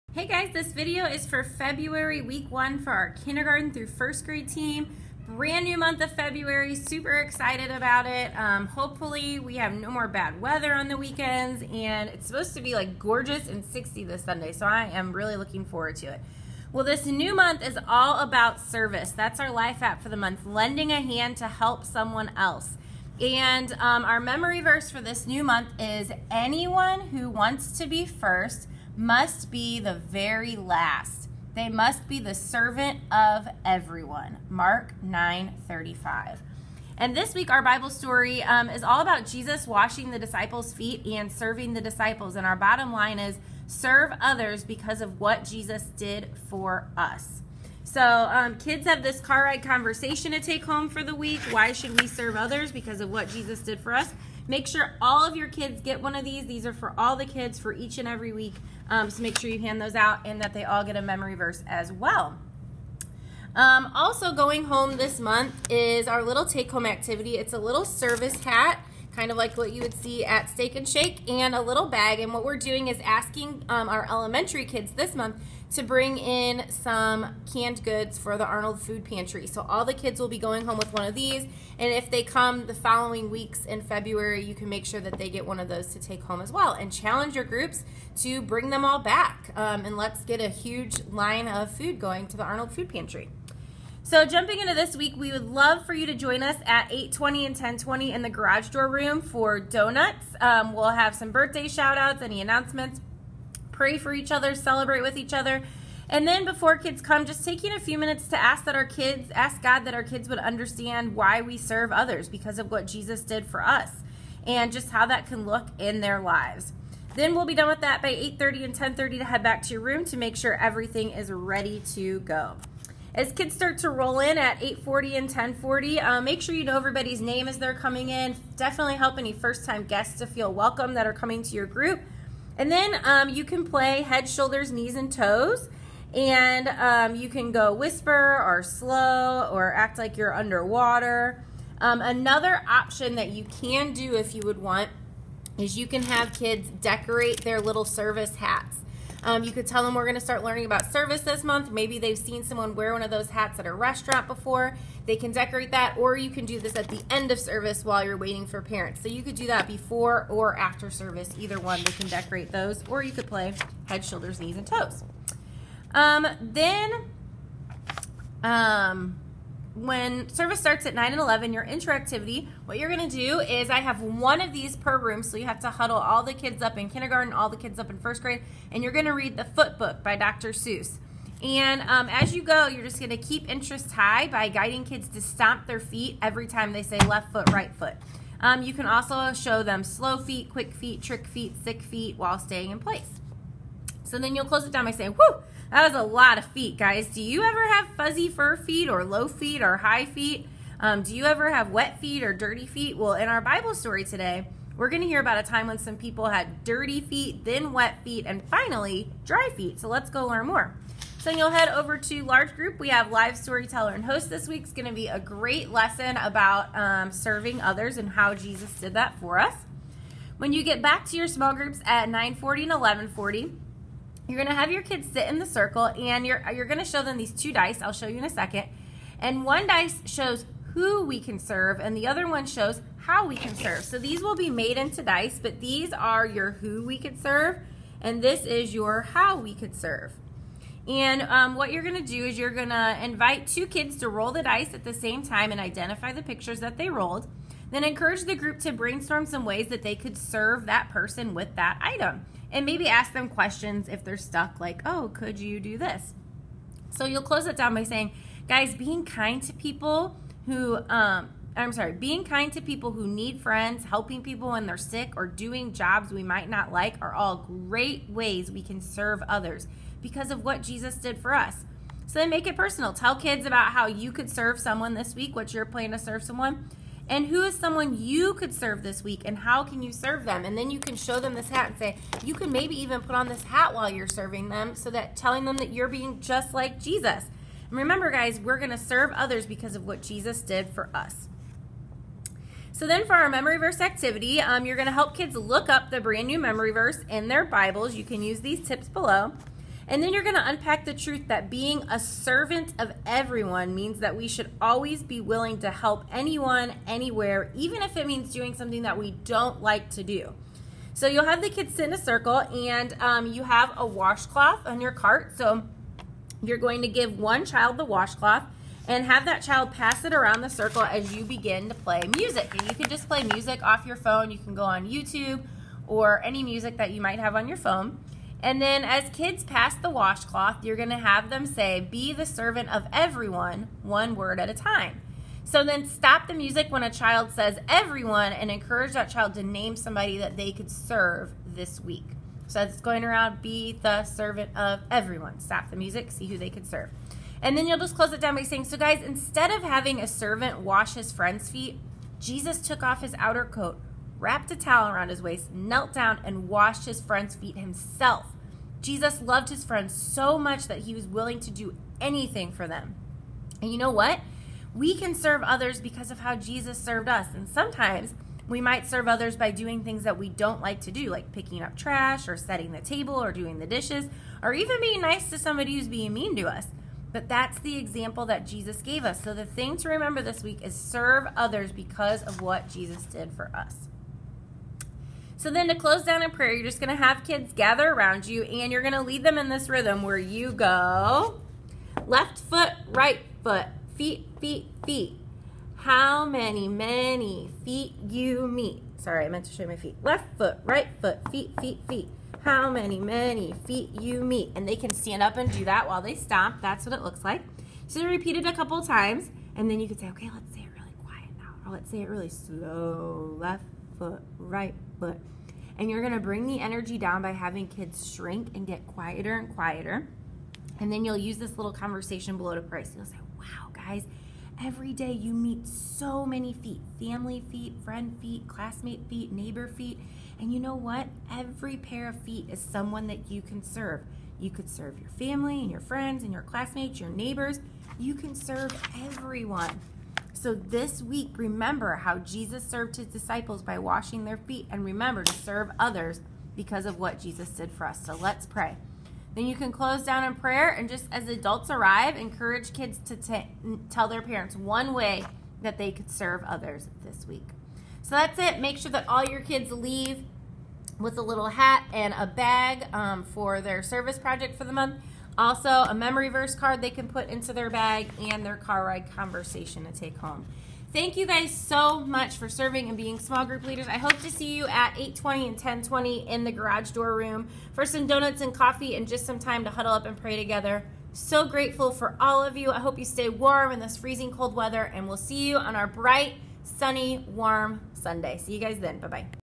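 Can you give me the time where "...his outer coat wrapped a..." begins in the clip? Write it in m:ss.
5:53.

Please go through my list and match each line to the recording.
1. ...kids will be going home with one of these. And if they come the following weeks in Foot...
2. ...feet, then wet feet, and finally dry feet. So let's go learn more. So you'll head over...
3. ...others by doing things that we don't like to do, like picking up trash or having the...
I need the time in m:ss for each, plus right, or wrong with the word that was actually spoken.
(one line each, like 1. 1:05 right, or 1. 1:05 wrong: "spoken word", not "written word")
1. 1:19 wrong: "February", not "Foot"
2. 3:26 right
3. 6:09 wrong: "setting", not "having".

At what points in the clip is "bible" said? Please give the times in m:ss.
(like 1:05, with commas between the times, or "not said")
0:37, 3:23, 4:57.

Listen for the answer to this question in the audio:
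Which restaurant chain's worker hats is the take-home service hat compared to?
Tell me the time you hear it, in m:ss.
1:10.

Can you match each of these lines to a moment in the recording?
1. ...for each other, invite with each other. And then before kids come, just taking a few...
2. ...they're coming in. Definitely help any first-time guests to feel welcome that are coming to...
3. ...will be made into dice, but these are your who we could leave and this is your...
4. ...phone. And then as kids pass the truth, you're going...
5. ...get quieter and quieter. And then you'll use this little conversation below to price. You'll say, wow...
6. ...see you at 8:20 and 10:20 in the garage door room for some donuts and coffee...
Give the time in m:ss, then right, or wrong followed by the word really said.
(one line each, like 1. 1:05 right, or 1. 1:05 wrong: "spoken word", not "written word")
1. 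1:43 wrong: "celebrate", not "invite"
2. 2:07 right
3. 3:54 wrong: "serve", not "leave"
4. 5:27 wrong: "washcloth", not "truth"
5. 6:58 right
6. 7:54 right.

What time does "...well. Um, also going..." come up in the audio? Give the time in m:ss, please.
1:01.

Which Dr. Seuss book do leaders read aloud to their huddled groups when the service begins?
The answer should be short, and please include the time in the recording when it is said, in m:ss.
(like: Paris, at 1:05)
The Foot Book, at 2:59.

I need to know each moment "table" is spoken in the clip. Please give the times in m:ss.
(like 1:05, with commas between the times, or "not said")
6:12.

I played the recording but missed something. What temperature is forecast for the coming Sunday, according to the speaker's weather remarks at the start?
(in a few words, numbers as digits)
60.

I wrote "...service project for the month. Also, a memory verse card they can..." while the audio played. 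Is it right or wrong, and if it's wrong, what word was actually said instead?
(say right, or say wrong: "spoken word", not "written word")
right.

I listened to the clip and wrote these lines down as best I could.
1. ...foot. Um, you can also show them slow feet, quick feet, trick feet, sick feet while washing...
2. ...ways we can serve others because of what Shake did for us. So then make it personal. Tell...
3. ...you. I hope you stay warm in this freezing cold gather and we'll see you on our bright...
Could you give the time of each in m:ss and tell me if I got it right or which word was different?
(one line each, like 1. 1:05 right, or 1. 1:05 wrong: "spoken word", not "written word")
1. 3:07 wrong: "staying", not "washing"
2. 4:28 wrong: "Jesus", not "Shake"
3. 8:02 wrong: "weather", not "gather".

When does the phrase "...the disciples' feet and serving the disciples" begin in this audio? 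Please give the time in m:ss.
0:40.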